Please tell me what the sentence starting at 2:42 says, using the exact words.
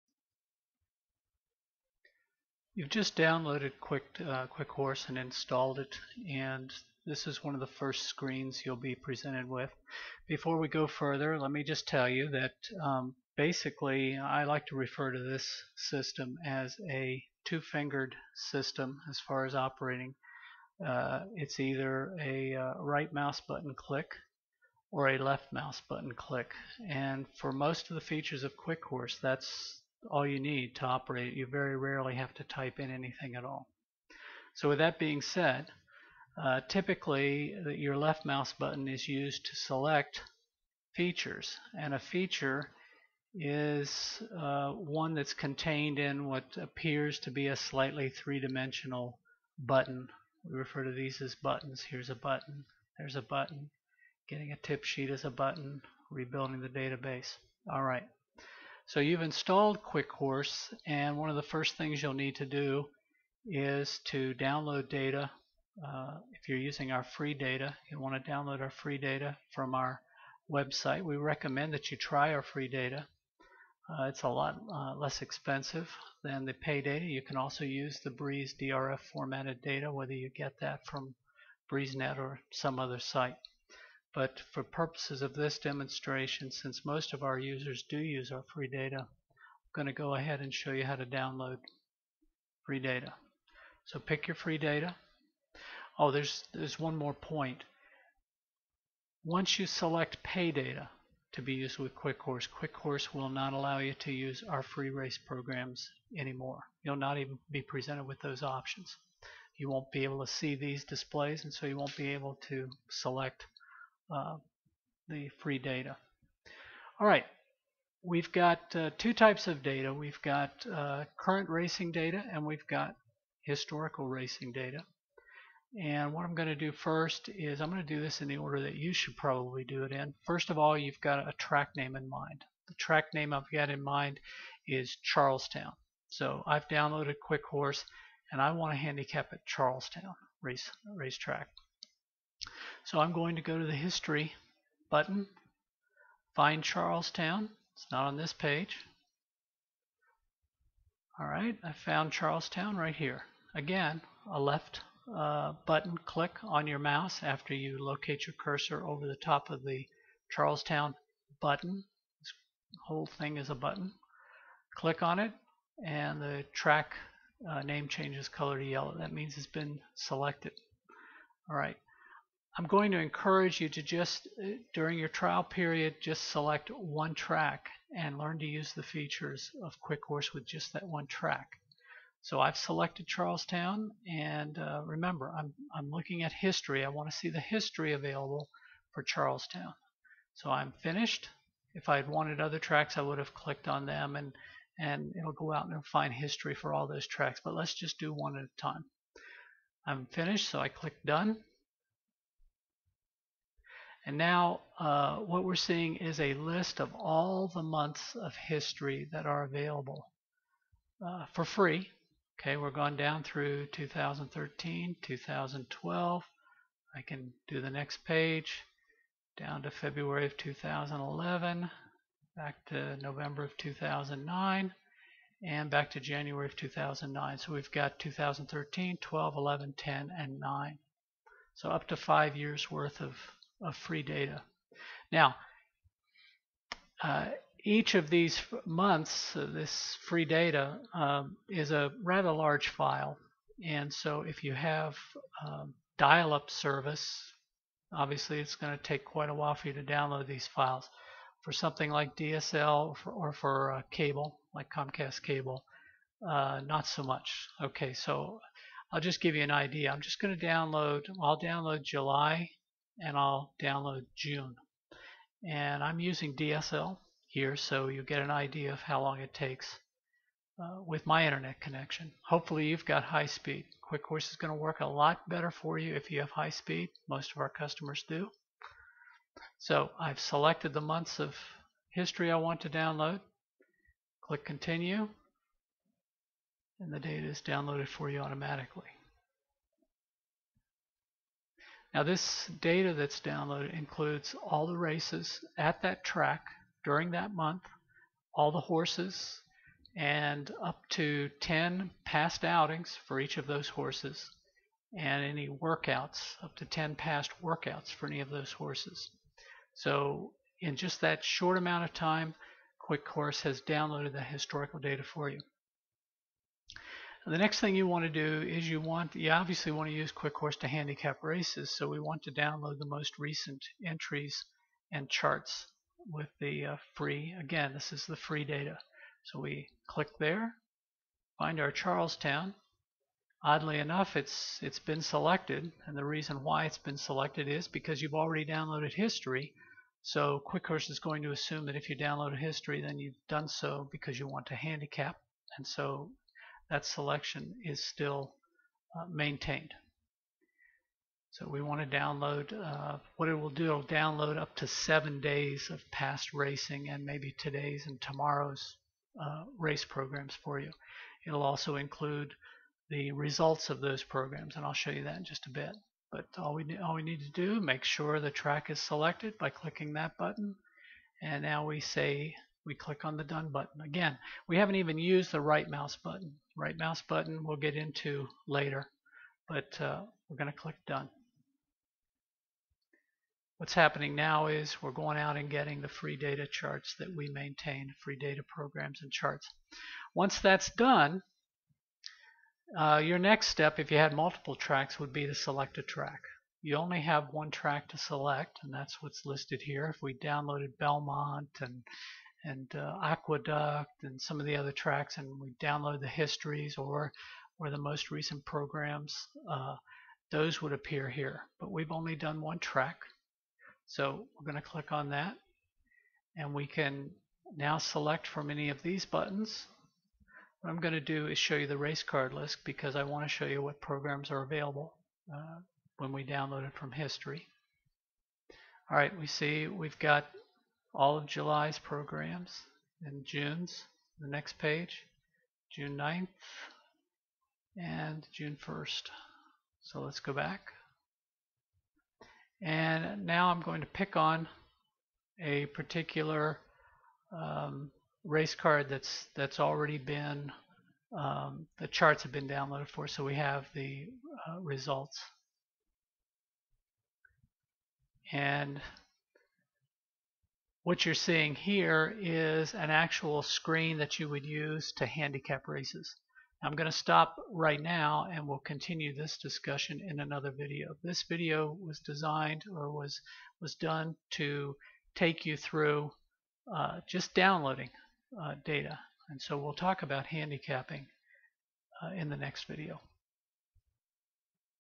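This whole thing is a button.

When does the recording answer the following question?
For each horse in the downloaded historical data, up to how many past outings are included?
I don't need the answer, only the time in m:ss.
5:01.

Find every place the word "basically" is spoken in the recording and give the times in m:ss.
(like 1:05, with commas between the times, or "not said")
0:13.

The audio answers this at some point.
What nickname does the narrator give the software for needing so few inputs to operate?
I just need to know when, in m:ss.
0:17.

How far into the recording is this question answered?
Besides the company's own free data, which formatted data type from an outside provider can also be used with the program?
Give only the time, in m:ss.
1:18.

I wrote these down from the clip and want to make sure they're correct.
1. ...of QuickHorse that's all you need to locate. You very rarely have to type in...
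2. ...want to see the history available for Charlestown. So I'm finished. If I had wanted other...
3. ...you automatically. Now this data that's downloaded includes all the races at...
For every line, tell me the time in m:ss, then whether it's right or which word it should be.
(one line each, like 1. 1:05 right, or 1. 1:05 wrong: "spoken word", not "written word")
1. 0:28 wrong: "operate", not "locate"
2. 3:06 right
3. 4:48 right.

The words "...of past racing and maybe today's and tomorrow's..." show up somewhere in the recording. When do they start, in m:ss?
5:55.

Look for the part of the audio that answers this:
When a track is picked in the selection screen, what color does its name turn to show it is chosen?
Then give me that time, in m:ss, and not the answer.
2:48.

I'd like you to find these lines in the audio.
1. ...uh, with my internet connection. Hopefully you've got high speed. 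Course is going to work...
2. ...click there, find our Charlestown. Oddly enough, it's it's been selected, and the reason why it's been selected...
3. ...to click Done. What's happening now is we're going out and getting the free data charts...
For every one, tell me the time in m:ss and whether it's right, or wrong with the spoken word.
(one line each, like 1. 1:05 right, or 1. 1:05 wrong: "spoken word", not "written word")
1. 4:30 right
2. 5:29 right
3. 6:20 right.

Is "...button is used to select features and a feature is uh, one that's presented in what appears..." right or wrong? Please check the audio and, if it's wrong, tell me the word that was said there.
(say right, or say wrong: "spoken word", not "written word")
wrong: "contained", not "presented".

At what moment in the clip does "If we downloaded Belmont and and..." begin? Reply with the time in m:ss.
6:39.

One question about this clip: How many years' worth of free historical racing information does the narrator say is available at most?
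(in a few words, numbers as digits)
5.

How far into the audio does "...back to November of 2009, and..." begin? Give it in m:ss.
3:42.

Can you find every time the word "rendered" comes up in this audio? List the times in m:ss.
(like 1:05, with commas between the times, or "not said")
not said.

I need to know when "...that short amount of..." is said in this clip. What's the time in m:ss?
5:11.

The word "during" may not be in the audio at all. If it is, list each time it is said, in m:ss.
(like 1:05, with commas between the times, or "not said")
2:54, 4:56.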